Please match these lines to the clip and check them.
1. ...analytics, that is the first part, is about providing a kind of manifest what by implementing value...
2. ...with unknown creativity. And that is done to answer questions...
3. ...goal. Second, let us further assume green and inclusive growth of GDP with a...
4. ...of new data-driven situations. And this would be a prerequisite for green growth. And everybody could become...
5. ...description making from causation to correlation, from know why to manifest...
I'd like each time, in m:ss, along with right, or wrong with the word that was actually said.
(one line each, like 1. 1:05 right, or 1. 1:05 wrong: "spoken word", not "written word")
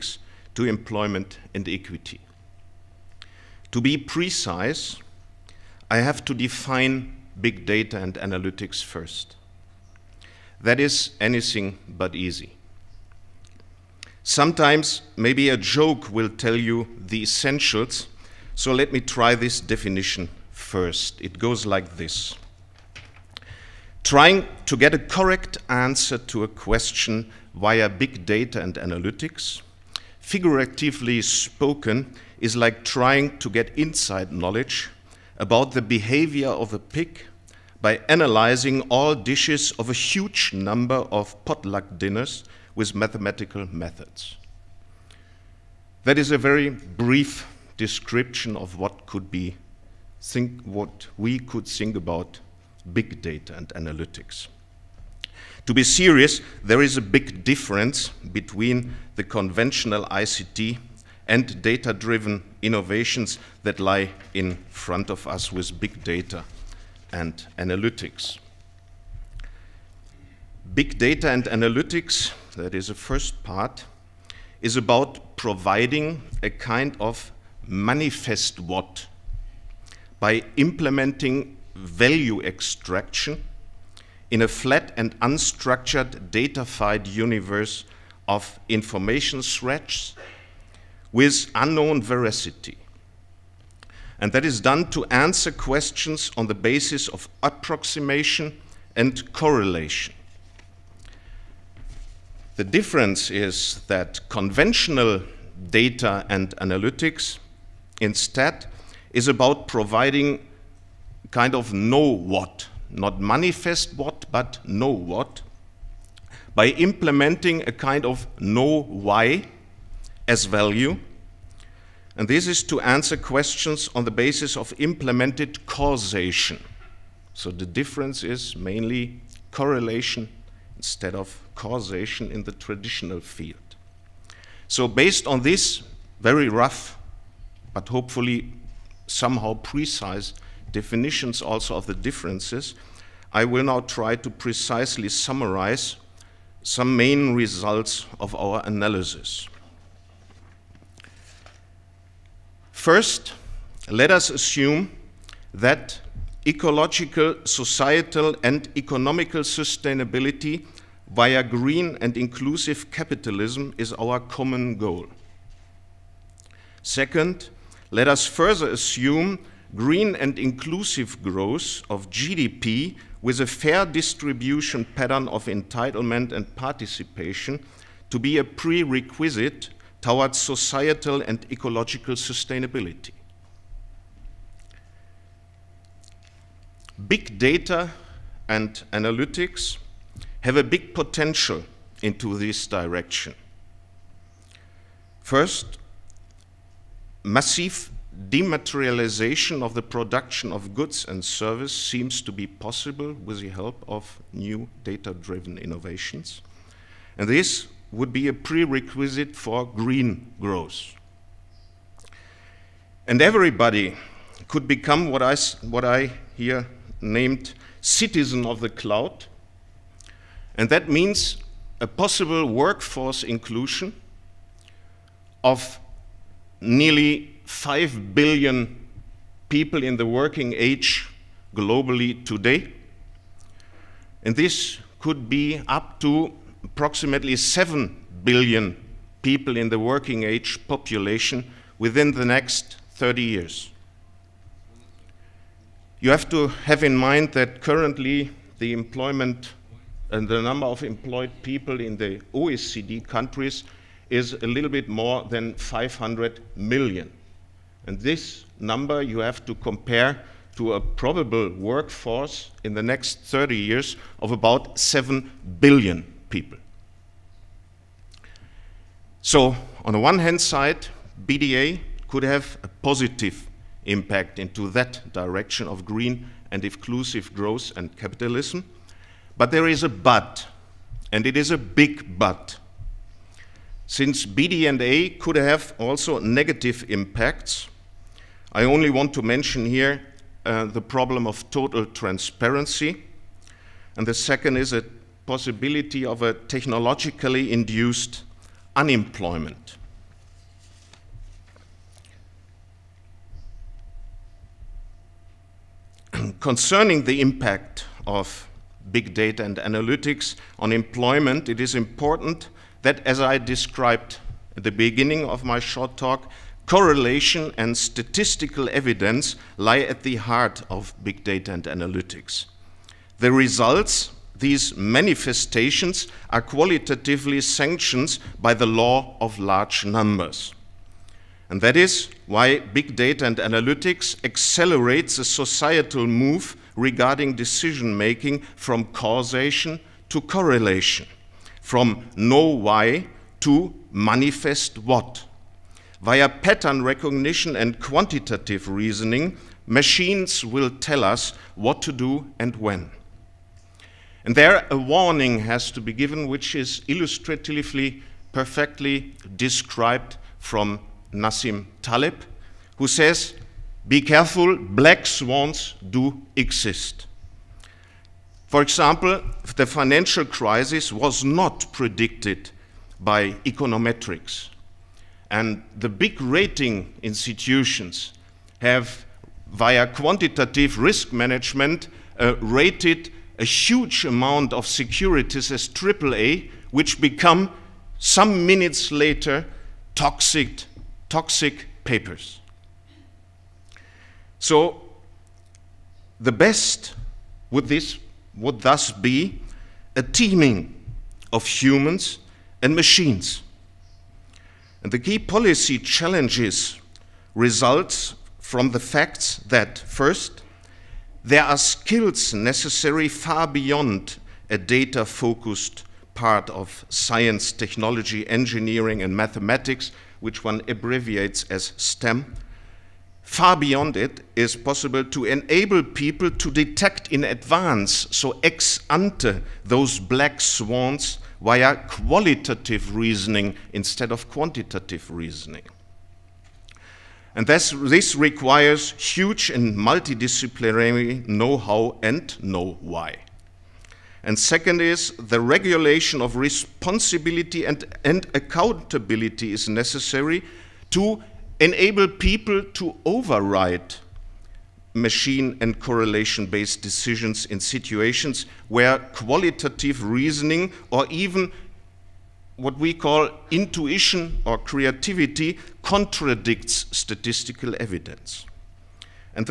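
1. 1:11 right
2. 1:31 wrong: "veracity", not "creativity"
3. 2:44 right
4. 3:23 wrong: "innovations", not "situations"
5. 5:37 wrong: "decision", not "description".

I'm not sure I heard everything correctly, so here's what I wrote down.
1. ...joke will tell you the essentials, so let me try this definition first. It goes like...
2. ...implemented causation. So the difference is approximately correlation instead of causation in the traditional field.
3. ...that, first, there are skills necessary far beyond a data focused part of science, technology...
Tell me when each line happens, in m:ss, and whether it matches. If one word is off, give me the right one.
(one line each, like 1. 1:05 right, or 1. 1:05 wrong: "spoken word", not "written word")
1. 0:15 right
2. 2:04 wrong: "mainly", not "approximately"
3. 6:49 right.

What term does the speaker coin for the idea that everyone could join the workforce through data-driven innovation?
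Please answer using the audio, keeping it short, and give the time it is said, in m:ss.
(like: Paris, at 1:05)
Citizen of the cloud, at 3:37.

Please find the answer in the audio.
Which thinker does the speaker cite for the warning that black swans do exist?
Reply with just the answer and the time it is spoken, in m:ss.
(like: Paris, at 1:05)
Nassim Taleb, at 6:01.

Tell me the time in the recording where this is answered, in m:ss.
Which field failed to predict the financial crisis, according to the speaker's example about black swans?
6:13.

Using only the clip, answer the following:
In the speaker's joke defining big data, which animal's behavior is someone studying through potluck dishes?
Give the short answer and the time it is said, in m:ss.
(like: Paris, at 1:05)
Pig, at 0:36.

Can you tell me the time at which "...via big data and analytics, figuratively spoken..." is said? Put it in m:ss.
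0:27.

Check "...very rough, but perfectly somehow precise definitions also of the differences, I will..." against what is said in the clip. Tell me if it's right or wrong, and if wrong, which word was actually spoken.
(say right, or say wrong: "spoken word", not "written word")
wrong: "hopefully", not "perfectly".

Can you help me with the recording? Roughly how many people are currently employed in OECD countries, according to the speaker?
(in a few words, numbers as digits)
500 million.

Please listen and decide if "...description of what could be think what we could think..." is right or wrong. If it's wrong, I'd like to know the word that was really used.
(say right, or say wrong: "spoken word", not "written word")
right.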